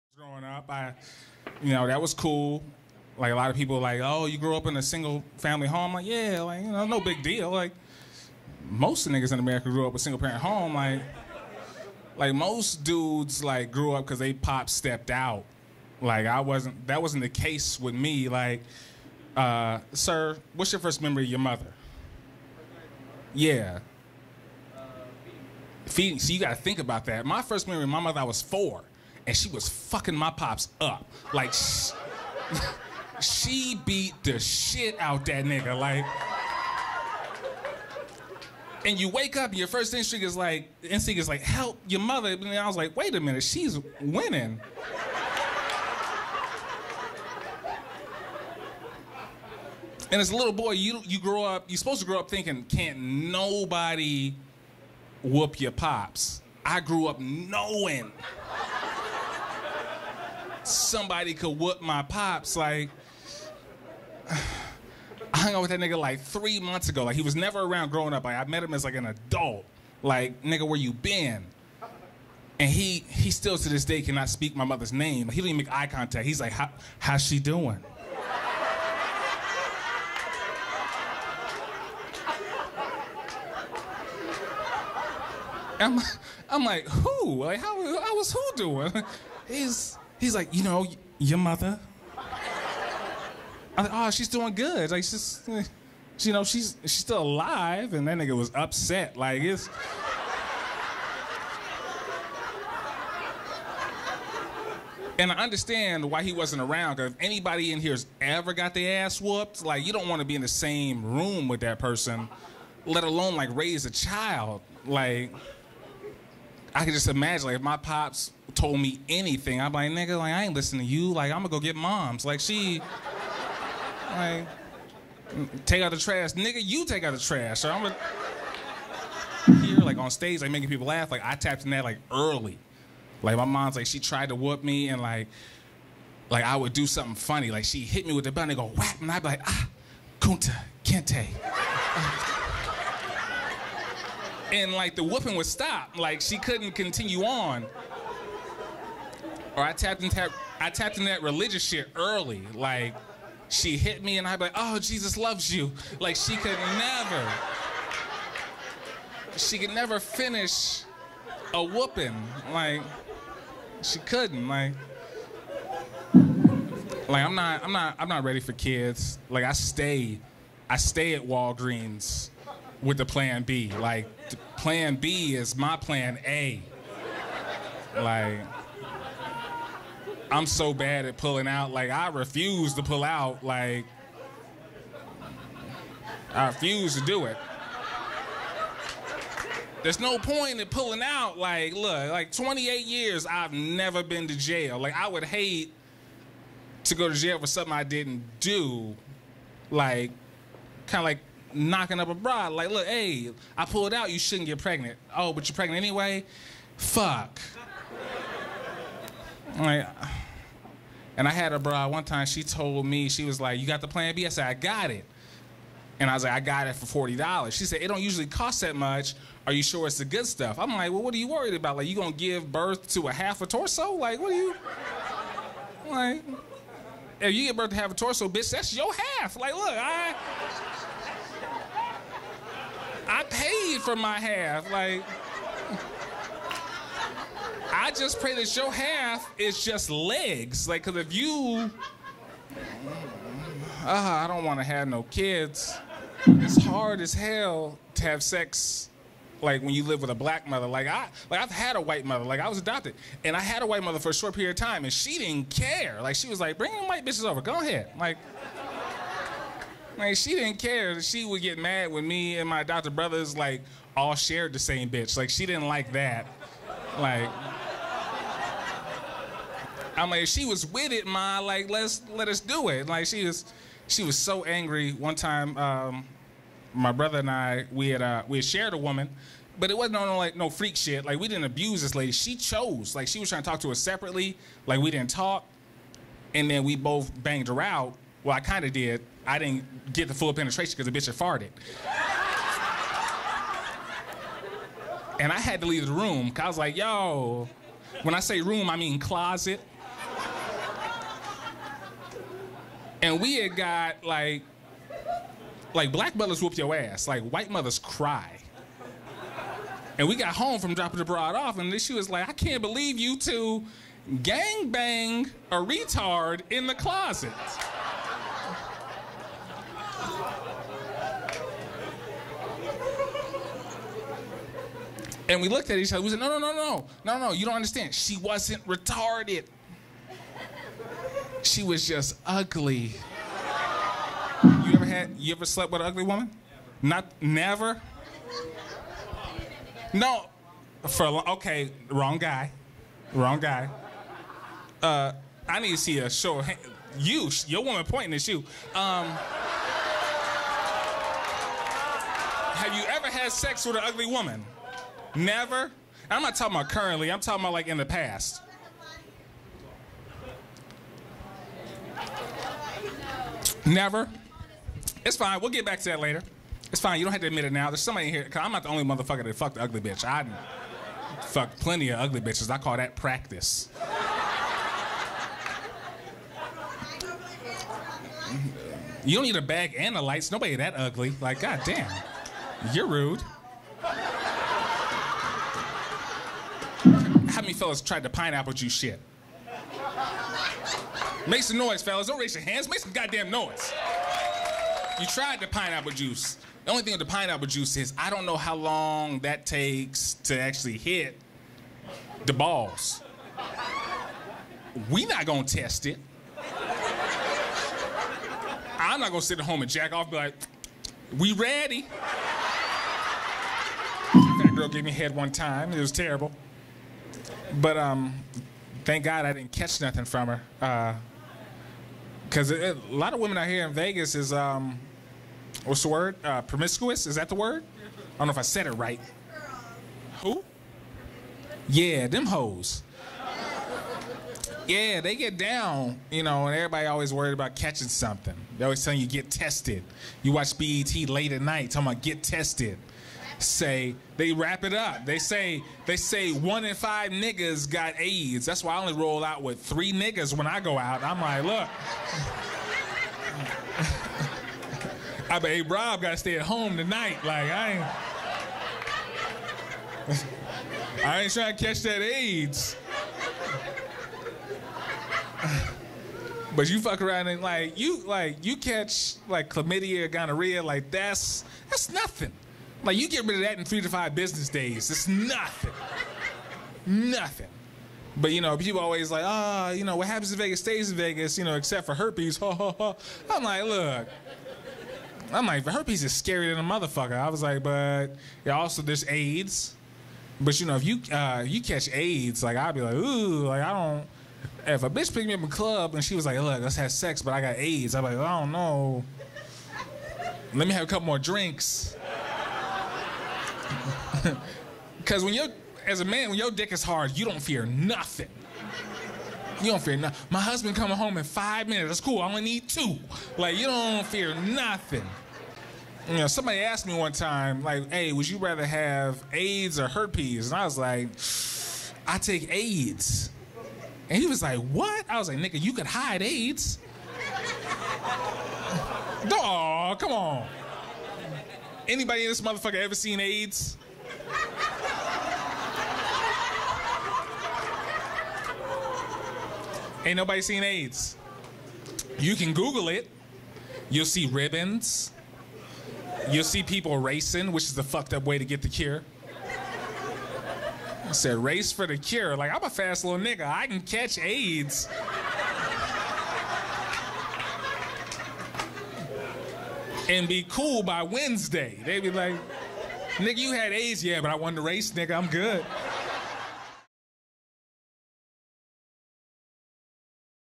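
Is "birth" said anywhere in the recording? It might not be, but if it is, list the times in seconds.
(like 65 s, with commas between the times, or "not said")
222 s, 227 s.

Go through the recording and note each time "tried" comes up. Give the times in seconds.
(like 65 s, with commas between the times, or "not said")
133 s, 387 s, 395 s.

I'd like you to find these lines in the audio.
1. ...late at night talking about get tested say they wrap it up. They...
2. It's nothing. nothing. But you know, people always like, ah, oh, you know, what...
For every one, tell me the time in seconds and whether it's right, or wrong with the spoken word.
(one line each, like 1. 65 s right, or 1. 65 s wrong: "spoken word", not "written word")
1. 441 s right
2. 474 s right.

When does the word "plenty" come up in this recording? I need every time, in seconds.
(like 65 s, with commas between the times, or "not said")
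371 s.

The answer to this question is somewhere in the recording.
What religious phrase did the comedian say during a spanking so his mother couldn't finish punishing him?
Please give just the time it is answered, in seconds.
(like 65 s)
154 s.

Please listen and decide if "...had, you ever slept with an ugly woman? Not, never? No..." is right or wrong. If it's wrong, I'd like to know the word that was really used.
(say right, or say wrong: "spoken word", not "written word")
right.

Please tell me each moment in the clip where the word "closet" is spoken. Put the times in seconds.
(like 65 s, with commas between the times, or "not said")
298 s, 316 s.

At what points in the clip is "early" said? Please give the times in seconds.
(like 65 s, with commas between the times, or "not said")
132 s, 151 s.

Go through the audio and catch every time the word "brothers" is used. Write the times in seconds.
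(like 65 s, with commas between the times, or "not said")
262 s, 276 s.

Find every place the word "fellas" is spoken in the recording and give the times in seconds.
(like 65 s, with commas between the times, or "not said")
387 s, 391 s.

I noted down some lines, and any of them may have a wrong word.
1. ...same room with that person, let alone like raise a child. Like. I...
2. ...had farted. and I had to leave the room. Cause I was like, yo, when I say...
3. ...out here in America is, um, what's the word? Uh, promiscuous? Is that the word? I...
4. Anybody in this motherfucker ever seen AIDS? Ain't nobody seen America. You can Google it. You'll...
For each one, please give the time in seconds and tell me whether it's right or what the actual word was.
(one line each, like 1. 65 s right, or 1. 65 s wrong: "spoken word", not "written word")
1. 110 s right
2. 291 s right
3. 423 s wrong: "Vegas", not "America"
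4. 531 s wrong: "AIDS", not "America".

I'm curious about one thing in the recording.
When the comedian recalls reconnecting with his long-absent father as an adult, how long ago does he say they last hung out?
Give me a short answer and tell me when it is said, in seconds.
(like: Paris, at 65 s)
three months ago, at 66 s.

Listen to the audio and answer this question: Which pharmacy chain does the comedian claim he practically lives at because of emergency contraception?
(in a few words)
Walgreens.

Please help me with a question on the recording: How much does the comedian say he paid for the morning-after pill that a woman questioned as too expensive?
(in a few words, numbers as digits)
$40.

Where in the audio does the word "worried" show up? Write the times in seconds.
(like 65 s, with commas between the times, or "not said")
221 s, 437 s.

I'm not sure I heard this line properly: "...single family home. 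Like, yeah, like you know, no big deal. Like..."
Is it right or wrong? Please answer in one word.
right.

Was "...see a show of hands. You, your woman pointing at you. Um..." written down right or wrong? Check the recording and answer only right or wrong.
right.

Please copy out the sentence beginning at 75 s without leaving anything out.
He didn't even make eye contact.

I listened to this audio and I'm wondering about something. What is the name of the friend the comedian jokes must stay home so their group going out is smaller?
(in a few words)
Rob.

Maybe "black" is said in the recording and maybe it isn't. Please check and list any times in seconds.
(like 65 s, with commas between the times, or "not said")
250 s, 305 s.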